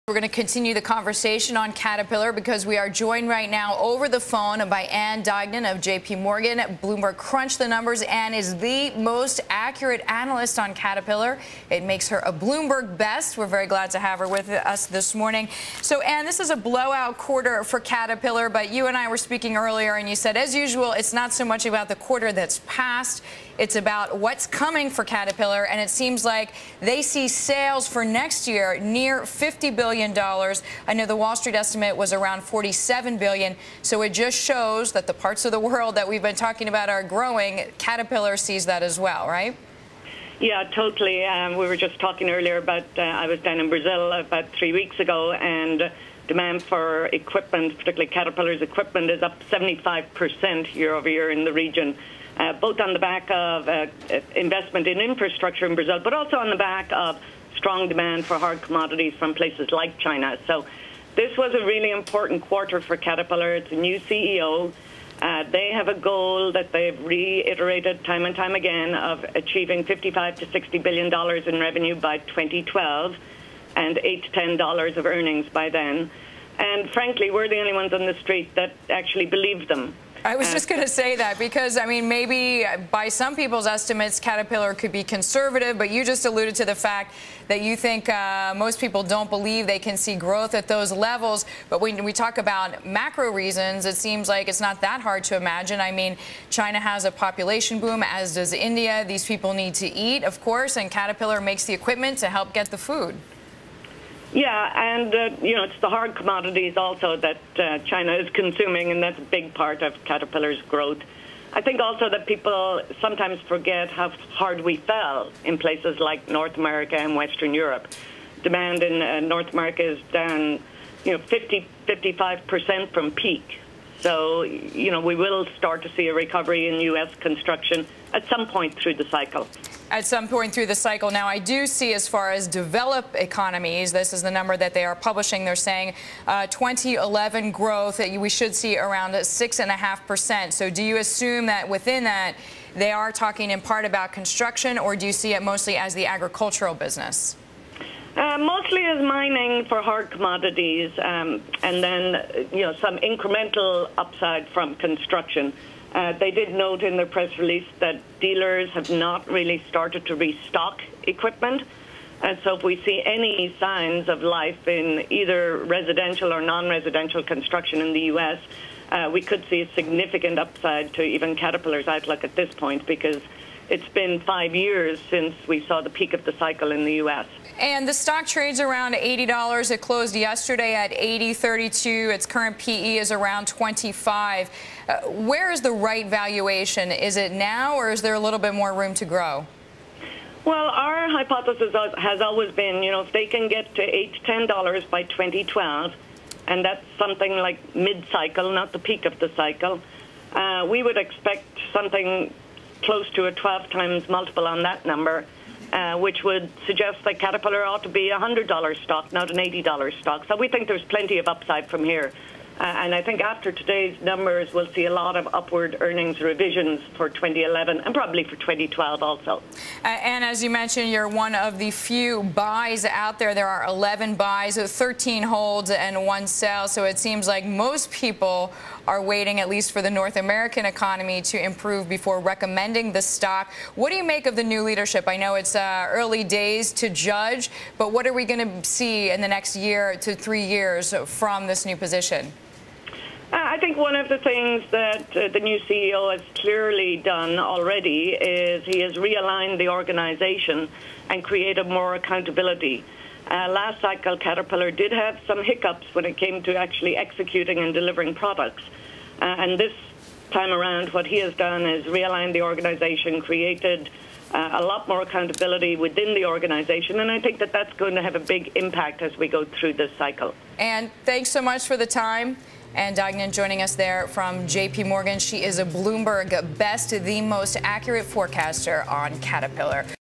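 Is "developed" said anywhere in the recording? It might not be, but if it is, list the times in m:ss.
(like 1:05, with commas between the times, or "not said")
2:12.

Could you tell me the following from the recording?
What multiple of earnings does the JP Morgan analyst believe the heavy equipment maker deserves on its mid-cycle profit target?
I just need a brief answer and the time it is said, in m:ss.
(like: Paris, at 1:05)
12 times, at 3:23.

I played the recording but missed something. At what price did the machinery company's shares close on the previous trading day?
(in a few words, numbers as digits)
$80.32.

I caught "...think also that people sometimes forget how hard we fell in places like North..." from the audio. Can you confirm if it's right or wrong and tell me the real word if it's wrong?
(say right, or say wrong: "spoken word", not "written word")
right.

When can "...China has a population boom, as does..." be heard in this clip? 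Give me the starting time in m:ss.
1:36.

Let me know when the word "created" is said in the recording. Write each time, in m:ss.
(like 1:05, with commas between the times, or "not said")
4:11, 4:23.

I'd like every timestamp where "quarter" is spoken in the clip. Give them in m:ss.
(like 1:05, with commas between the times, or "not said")
0:17, 0:21, 1:02.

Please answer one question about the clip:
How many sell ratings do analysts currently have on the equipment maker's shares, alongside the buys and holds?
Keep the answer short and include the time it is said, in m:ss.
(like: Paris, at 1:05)
1, at 3:46.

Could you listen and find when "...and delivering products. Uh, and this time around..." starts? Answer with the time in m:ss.
4:17.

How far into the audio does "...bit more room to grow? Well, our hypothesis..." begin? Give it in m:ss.
3:08.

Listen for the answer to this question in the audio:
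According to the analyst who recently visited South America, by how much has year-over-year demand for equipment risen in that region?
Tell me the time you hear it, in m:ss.
0:49.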